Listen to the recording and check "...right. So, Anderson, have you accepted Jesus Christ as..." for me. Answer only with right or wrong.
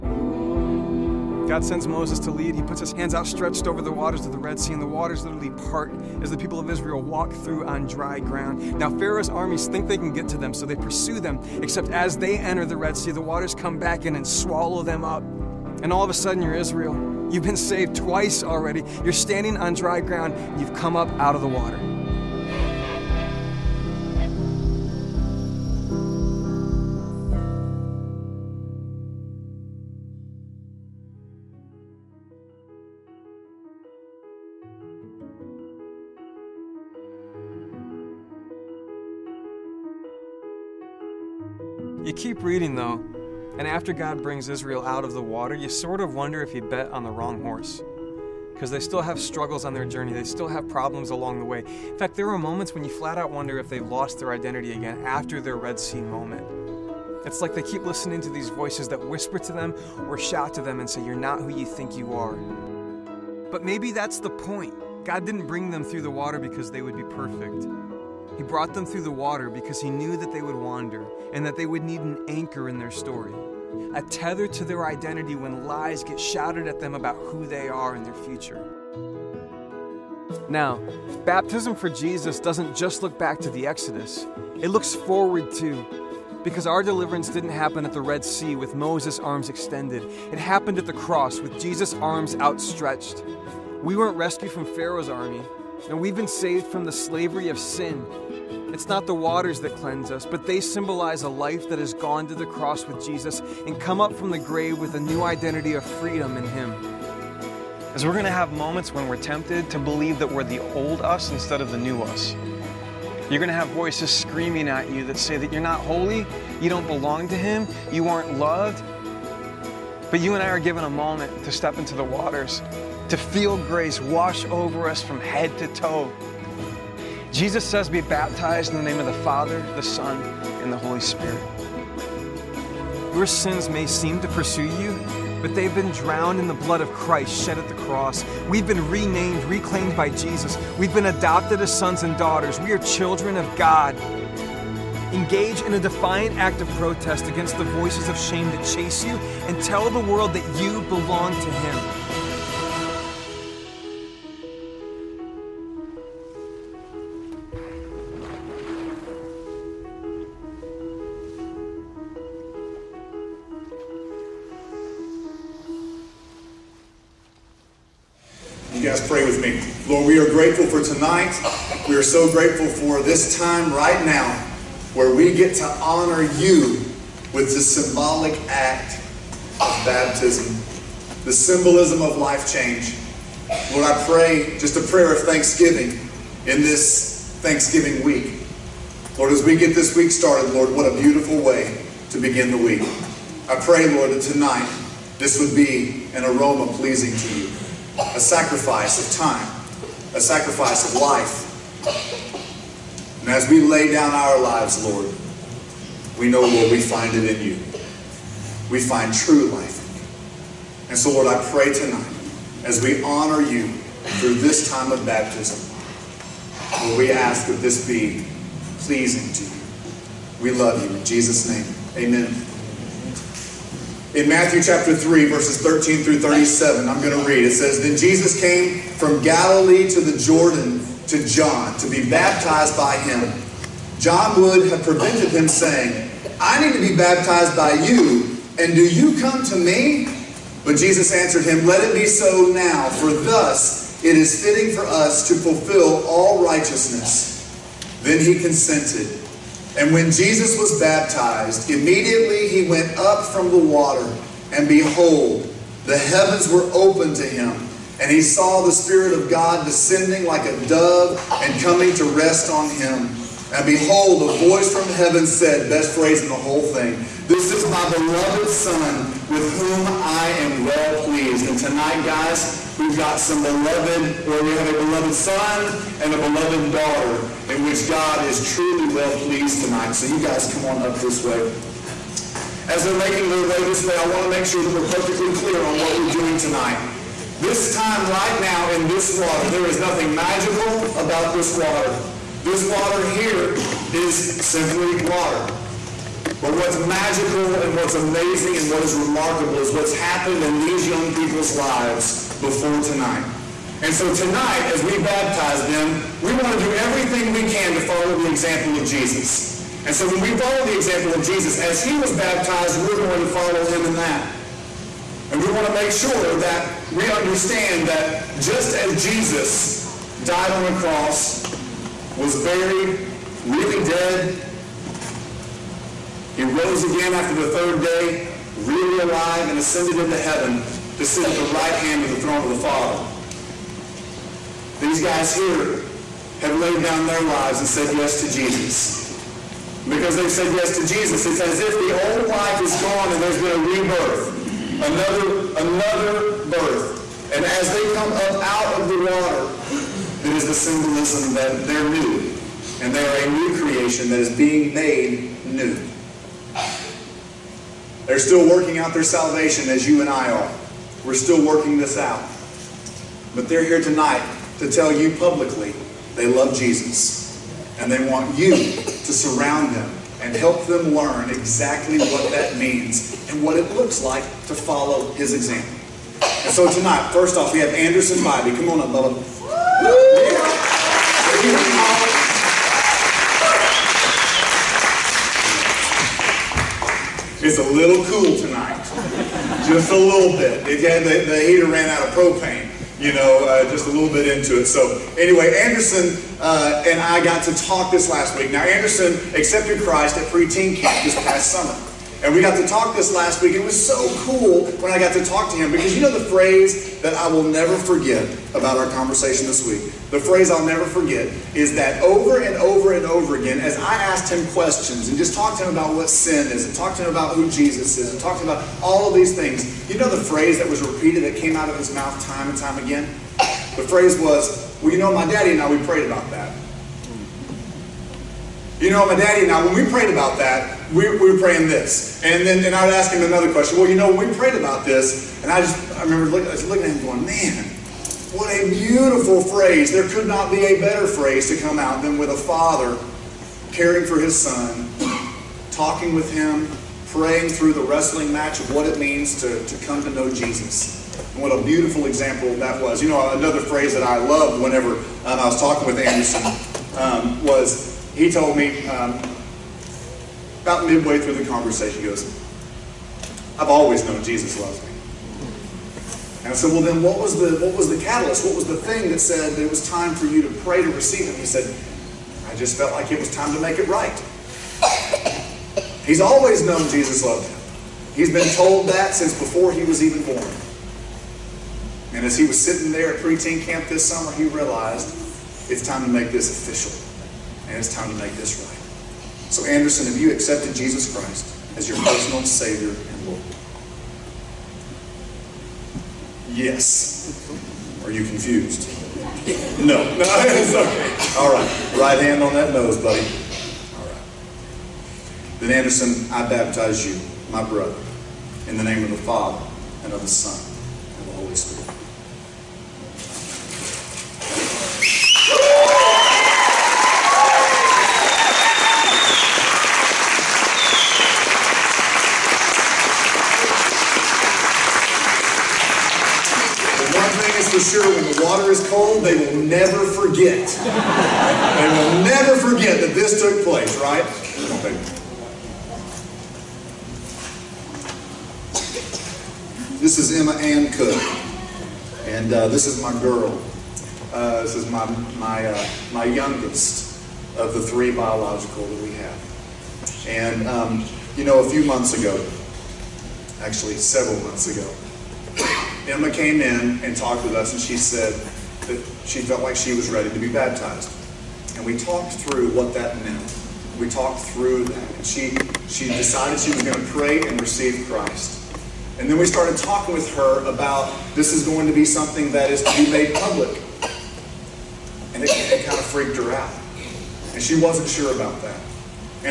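right.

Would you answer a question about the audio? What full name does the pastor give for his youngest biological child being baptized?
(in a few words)
Emma Ann Cook.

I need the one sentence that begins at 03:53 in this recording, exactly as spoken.
John would have prevented him, saying, I need to be baptized by you, and do you come to me?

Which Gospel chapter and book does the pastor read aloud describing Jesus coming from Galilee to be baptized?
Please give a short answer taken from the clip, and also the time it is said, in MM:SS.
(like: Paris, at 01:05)
Matthew 3, at 03:44.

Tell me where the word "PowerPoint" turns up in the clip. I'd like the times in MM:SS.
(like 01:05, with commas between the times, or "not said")
not said.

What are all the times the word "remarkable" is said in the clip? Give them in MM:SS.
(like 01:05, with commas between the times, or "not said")
04:58.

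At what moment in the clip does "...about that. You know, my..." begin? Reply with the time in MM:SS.
07:06.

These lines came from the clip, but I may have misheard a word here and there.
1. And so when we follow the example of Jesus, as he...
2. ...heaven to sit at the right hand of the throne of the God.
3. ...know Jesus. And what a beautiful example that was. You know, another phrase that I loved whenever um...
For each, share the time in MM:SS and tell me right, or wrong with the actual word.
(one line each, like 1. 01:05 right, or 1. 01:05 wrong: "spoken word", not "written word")
1. 05:09 right
2. 05:30 wrong: "Father", not "God"
3. 07:30 right.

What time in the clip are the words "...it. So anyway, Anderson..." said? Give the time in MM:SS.
06:34.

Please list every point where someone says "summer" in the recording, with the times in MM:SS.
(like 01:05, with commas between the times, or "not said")
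06:41, 08:04.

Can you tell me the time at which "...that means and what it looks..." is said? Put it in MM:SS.
06:12.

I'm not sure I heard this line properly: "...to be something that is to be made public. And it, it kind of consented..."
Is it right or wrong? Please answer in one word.
wrong.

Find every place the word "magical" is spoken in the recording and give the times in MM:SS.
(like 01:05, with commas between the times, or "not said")
04:50, 04:56.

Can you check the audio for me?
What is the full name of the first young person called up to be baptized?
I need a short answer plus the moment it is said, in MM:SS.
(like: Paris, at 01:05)
Anderson Bobby, at 06:17.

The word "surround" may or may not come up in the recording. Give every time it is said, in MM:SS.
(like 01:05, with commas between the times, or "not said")
06:09.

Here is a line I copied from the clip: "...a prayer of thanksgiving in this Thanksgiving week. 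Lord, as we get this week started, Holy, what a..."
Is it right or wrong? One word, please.
wrong.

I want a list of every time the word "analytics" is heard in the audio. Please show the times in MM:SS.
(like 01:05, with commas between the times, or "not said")
not said.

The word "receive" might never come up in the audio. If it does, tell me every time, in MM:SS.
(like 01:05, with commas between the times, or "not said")
07:50, 09:27.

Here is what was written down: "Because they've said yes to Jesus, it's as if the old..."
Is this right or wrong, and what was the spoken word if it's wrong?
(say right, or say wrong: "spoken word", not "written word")
right.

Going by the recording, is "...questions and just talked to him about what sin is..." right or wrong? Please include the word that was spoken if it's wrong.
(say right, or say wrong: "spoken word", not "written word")
right.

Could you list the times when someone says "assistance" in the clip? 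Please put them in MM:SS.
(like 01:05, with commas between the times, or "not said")
not said.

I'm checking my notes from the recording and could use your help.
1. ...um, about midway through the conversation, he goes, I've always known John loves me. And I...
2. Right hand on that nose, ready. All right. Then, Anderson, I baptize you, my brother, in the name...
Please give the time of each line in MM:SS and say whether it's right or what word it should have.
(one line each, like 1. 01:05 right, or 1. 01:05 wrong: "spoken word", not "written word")
1. 07:38 wrong: "Jesus", not "John"
2. 08:21 wrong: "buddy", not "ready".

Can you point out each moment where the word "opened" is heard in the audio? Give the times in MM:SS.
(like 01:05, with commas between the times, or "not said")
04:16.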